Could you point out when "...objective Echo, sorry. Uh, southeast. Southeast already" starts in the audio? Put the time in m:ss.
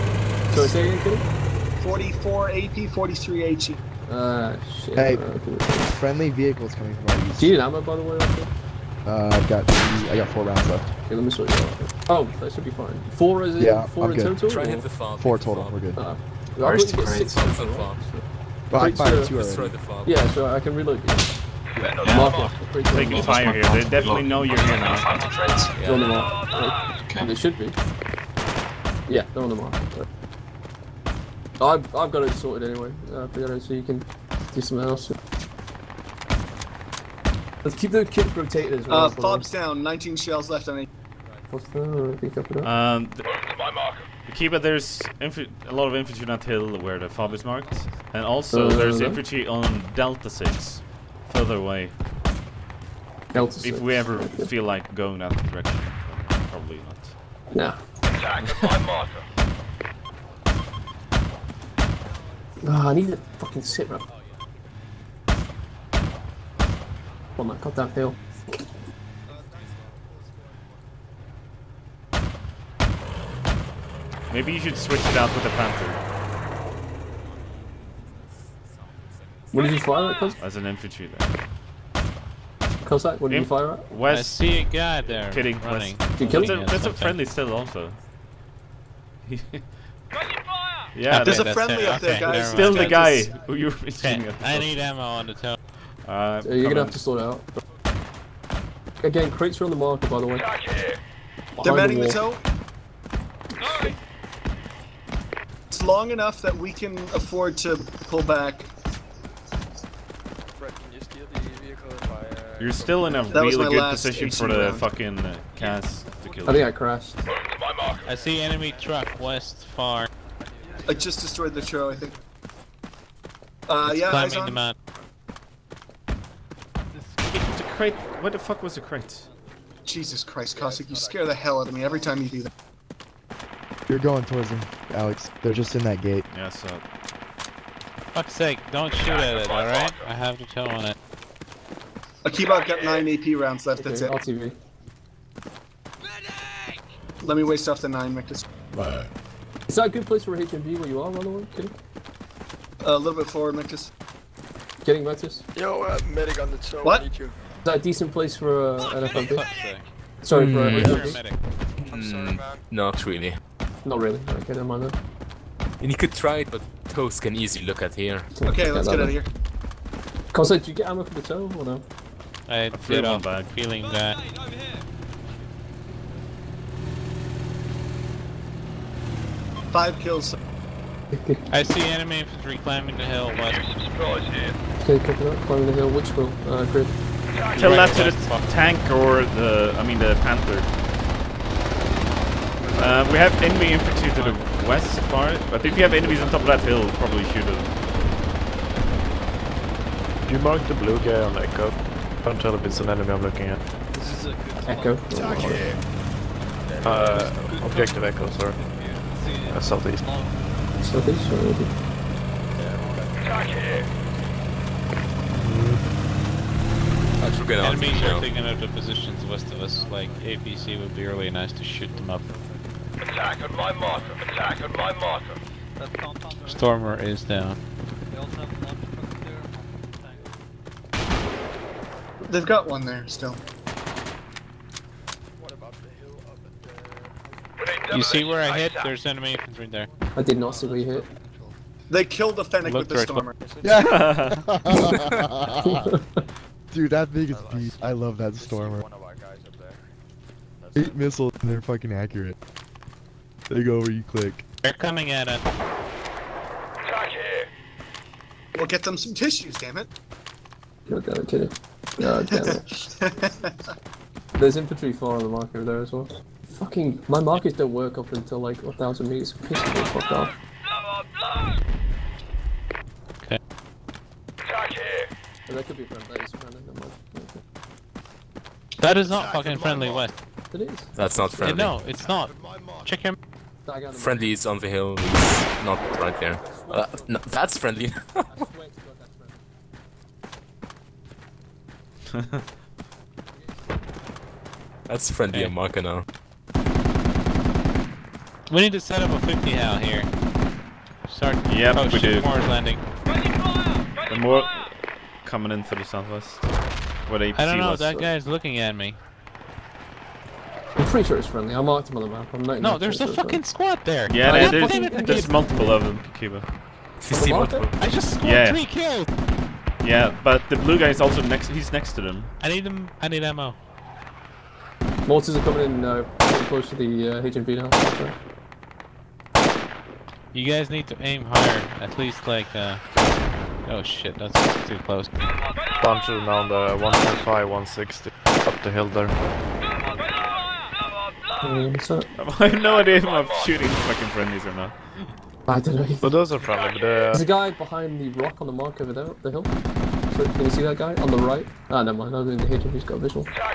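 3:27.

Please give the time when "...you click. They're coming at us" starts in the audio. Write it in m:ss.
4:13.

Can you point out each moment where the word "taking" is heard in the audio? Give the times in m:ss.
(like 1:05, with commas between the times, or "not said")
0:22, 3:38.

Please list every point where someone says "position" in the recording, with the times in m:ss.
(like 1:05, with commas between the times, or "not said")
1:53, 3:38.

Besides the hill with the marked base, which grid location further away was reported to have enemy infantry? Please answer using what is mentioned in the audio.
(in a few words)
Delta 6.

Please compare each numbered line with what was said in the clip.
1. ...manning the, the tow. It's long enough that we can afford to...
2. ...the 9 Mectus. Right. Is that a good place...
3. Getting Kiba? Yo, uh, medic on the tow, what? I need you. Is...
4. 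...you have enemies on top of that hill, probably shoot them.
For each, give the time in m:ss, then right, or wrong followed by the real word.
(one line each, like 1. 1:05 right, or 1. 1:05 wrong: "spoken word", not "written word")
1. 1:41 right
2. 2:27 right
3. 2:34 wrong: "Mectus", not "Kiba"
4. 3:15 right.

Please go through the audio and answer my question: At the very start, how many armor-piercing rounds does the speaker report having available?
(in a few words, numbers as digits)
44.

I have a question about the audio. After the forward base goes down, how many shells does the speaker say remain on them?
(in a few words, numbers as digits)
19.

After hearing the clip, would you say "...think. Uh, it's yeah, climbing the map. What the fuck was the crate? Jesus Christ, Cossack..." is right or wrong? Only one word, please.
right.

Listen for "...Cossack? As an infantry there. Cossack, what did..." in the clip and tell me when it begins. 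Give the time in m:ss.
1:20.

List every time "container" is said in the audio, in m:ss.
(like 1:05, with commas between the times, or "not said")
not said.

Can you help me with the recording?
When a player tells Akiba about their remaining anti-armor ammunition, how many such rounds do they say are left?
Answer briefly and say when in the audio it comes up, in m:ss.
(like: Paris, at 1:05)
9, at 2:22.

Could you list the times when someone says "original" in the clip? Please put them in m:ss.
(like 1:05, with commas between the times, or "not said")
not said.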